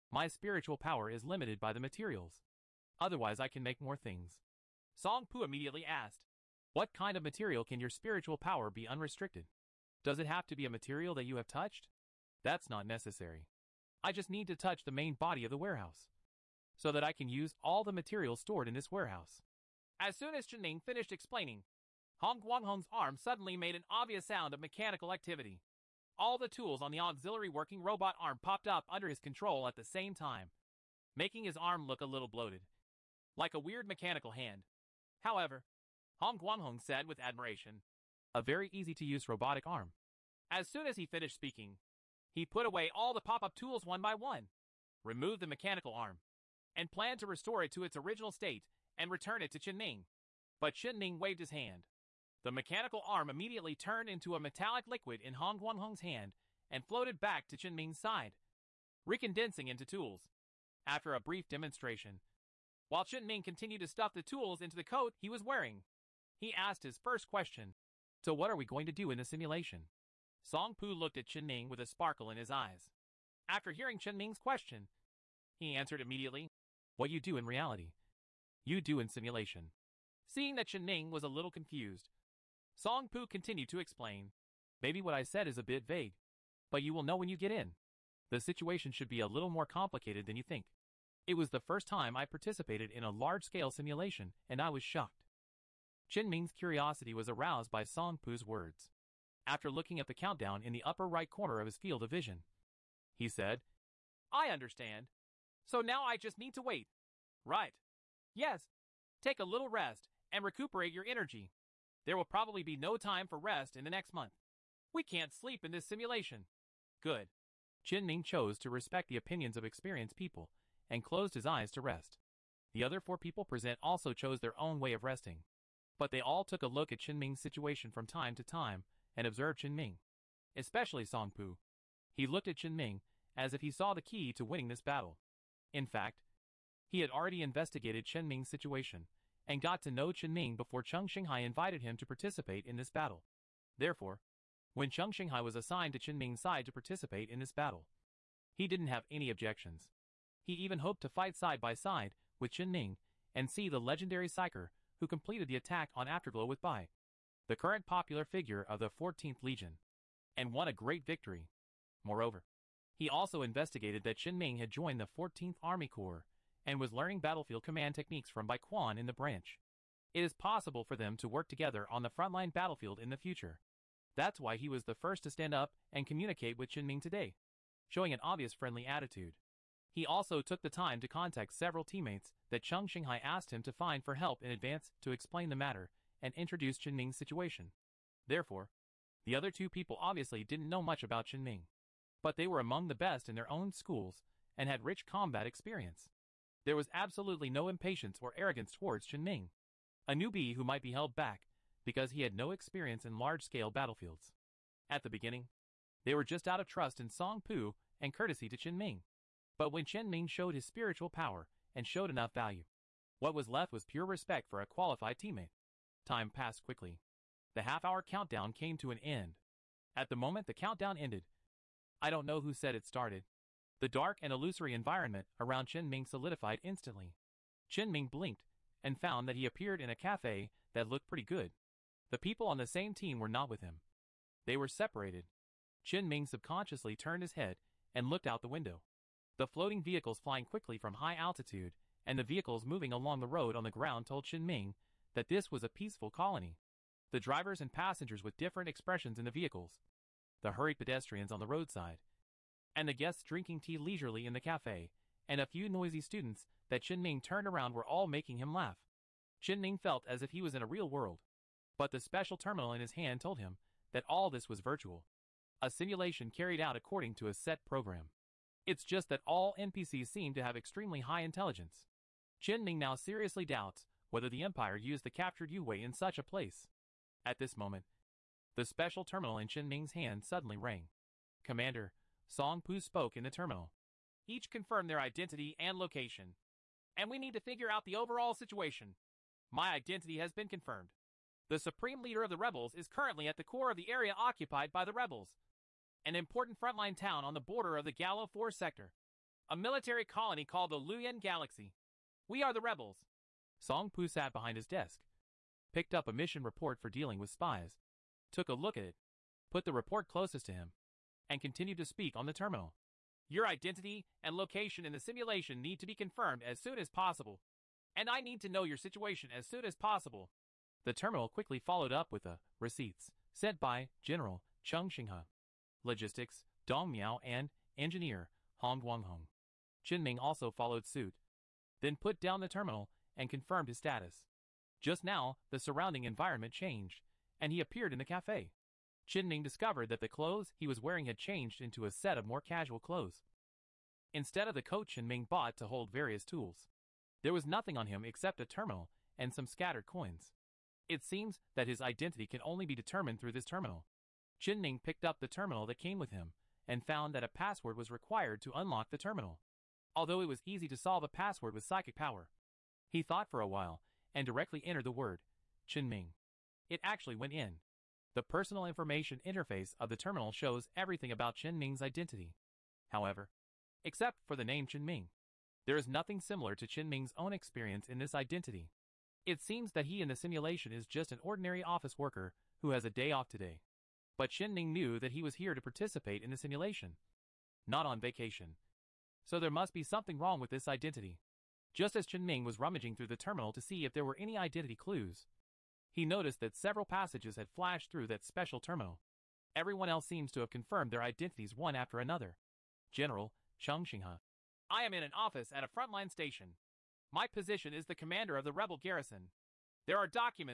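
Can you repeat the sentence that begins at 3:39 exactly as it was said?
At the moment the countdown ended, I don't know who said it started.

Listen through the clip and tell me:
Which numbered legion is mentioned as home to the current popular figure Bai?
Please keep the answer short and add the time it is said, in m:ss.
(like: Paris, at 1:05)
14th Legion, at 2:38.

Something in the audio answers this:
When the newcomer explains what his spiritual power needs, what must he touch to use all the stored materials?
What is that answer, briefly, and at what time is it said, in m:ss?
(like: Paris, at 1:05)
The main body of the warehouse, at 0:14.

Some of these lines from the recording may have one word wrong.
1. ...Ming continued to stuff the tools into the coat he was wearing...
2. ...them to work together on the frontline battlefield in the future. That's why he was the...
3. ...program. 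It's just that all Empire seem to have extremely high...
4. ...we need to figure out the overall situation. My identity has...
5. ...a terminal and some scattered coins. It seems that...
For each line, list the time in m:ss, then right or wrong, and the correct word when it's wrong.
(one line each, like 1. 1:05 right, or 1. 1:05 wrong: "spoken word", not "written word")
1. 1:03 right
2. 2:50 right
3. 4:27 wrong: "NPCs", not "Empire"
4. 4:47 right
5. 5:48 right.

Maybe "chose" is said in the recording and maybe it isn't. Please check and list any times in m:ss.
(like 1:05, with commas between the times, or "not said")
1:58, 2:04.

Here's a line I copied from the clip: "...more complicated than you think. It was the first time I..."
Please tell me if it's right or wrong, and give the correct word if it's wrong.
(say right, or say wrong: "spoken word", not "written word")
right.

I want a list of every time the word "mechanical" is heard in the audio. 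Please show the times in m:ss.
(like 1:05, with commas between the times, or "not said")
0:24, 0:33, 0:45, 0:52.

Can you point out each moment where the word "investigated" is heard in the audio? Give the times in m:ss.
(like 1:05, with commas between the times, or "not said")
2:17, 2:43.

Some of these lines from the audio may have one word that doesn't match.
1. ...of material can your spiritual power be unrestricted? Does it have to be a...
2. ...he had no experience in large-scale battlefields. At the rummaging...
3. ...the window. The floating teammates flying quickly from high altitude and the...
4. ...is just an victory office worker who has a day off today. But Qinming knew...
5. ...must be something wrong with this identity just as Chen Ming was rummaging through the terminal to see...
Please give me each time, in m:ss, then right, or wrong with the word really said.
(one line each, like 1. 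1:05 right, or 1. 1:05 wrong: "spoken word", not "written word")
1. 0:07 right
2. 3:22 wrong: "beginning", not "rummaging"
3. 3:58 wrong: "vehicles", not "teammates"
4. 6:20 wrong: "ordinary", not "victory"
5. 6:29 right.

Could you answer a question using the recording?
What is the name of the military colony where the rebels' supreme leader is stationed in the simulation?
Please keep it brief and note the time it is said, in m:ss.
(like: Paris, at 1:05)
Luyan Galaxy, at 5:00.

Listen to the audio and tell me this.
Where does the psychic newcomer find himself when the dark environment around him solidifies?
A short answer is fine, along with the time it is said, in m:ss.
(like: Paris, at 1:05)
A cafe, at 3:49.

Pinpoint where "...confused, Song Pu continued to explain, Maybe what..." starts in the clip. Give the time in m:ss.
1:21.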